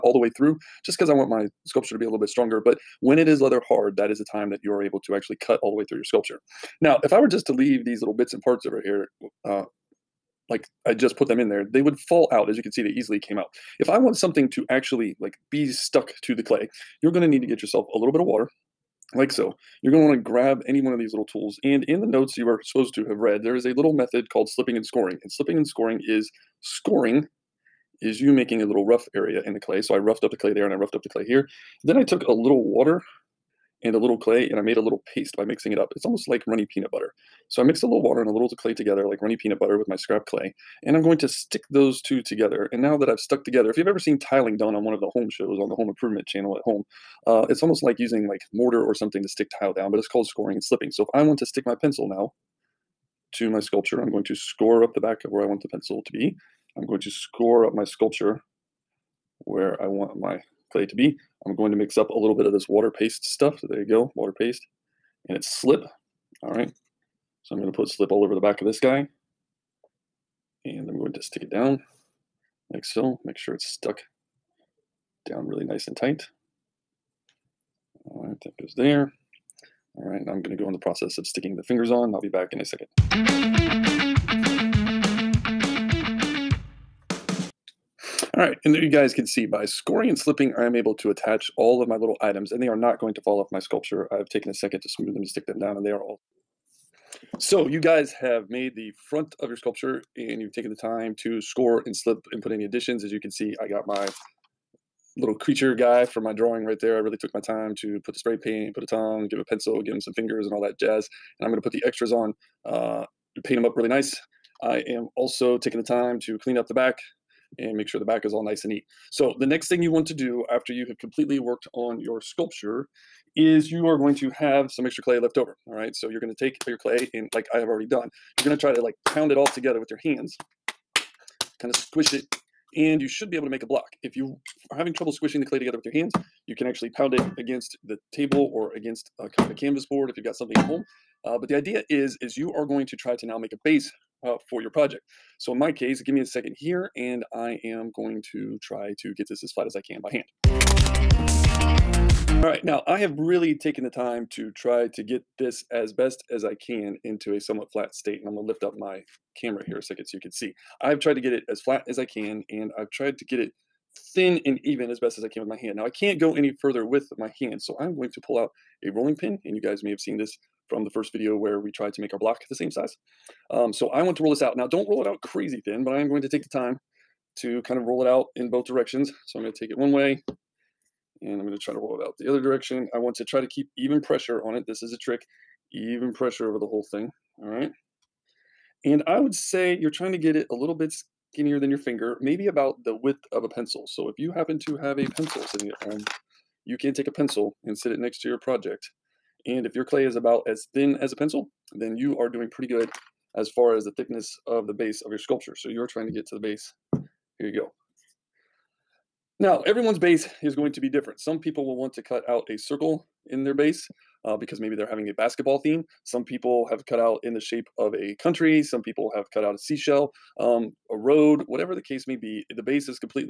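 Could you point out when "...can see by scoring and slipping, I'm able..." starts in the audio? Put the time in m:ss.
1:29.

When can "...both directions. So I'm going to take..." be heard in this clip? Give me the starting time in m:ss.
2:58.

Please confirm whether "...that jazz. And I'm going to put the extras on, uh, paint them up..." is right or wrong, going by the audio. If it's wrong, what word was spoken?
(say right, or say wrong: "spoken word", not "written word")
right.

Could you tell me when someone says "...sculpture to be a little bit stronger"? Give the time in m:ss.
0:01.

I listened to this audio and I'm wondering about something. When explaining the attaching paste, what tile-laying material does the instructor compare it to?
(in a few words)
mortar.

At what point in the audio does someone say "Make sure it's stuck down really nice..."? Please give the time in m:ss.
1:13.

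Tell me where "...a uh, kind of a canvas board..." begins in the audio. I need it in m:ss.
2:19.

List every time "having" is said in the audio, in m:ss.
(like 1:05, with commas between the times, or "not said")
2:14, 3:34.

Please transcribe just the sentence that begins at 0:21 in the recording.
And in the notes you are supposed to have read, there is a little method called slipping and scoring.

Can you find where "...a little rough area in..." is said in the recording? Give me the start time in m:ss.
0:28.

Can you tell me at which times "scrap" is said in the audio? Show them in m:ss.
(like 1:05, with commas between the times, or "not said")
0:39.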